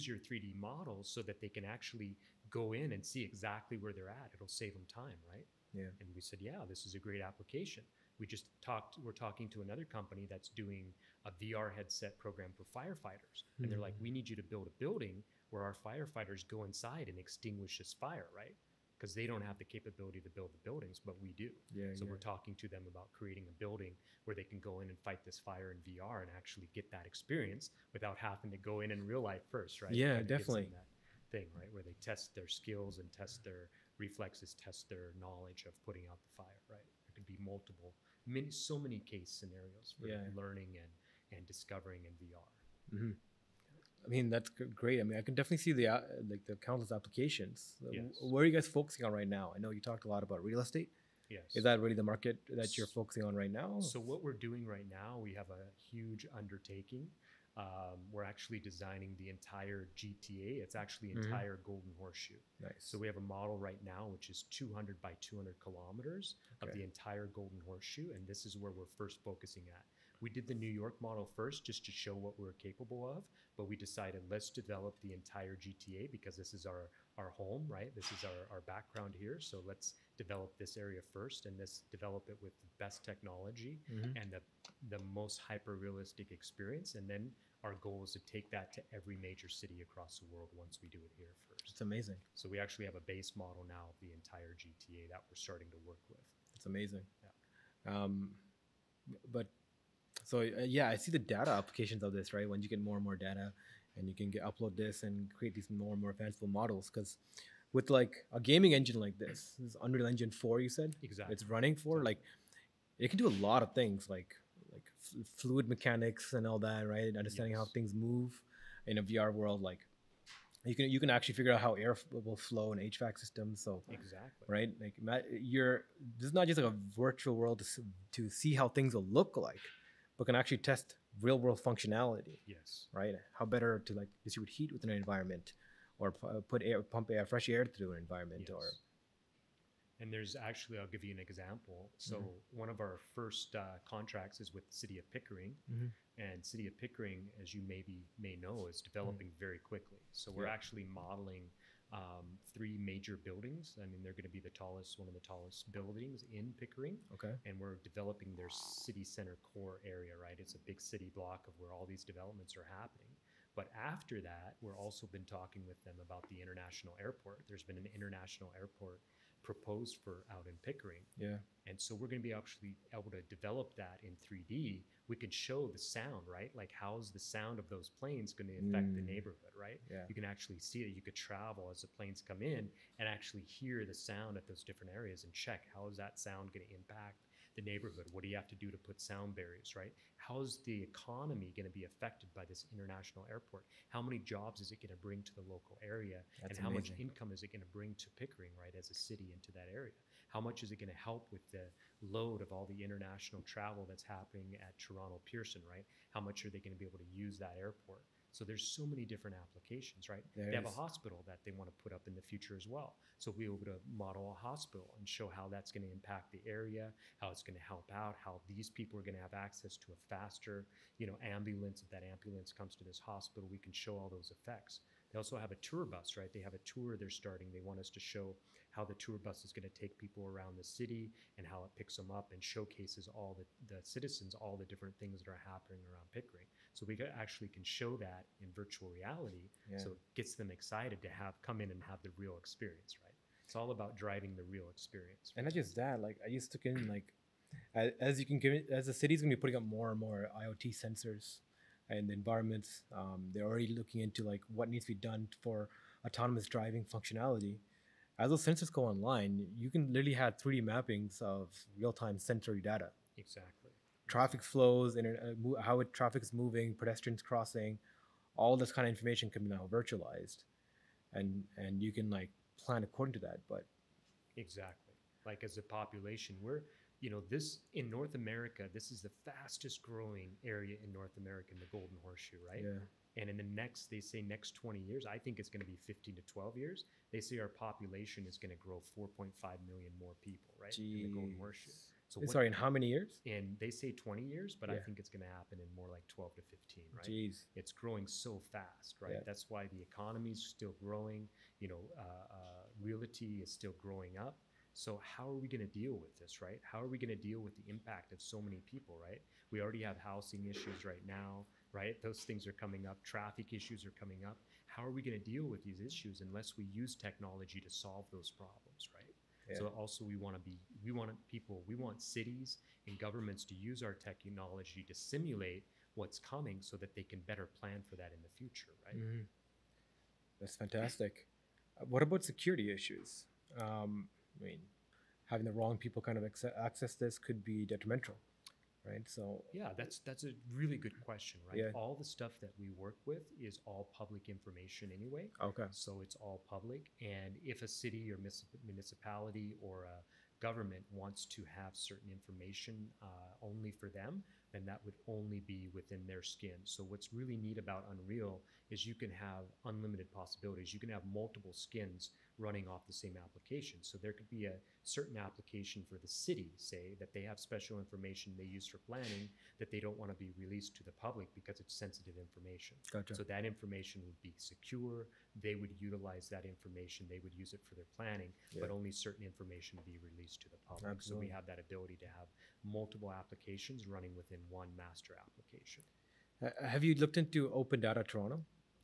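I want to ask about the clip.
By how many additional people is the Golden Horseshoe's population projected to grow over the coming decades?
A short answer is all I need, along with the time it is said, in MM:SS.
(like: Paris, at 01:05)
4.5 million, at 04:48.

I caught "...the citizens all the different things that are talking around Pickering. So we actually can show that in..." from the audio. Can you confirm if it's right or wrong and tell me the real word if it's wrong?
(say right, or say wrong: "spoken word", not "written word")
wrong: "happening", not "talking".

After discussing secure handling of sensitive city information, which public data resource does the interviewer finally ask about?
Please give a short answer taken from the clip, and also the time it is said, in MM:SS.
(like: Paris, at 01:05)
Open Data Toronto, at 06:27.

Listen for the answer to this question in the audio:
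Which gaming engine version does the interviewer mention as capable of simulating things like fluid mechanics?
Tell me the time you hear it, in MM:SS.
01:49.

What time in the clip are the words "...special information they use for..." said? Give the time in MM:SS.
06:07.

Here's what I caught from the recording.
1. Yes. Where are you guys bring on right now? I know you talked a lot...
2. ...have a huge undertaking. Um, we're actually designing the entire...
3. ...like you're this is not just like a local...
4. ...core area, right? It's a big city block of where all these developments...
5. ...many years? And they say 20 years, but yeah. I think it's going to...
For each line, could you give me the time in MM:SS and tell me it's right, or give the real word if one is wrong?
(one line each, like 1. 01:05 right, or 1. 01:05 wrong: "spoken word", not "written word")
1. 00:47 wrong: "focusing", not "bring"
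2. 00:55 right
3. 02:04 wrong: "virtual", not "local"
4. 02:39 right
5. 04:52 right.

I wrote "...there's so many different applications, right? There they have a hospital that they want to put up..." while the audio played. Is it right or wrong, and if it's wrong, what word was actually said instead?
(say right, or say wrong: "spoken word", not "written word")
right.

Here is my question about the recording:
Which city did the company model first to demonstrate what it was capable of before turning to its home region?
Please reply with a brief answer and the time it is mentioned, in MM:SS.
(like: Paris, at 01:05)
New York, at 01:10.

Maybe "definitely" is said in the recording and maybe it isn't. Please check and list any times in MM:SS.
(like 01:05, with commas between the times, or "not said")
00:30, 00:45.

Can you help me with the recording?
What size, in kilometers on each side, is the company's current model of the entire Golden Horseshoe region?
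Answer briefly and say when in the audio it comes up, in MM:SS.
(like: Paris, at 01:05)
200 by 200 kilometers, at 01:04.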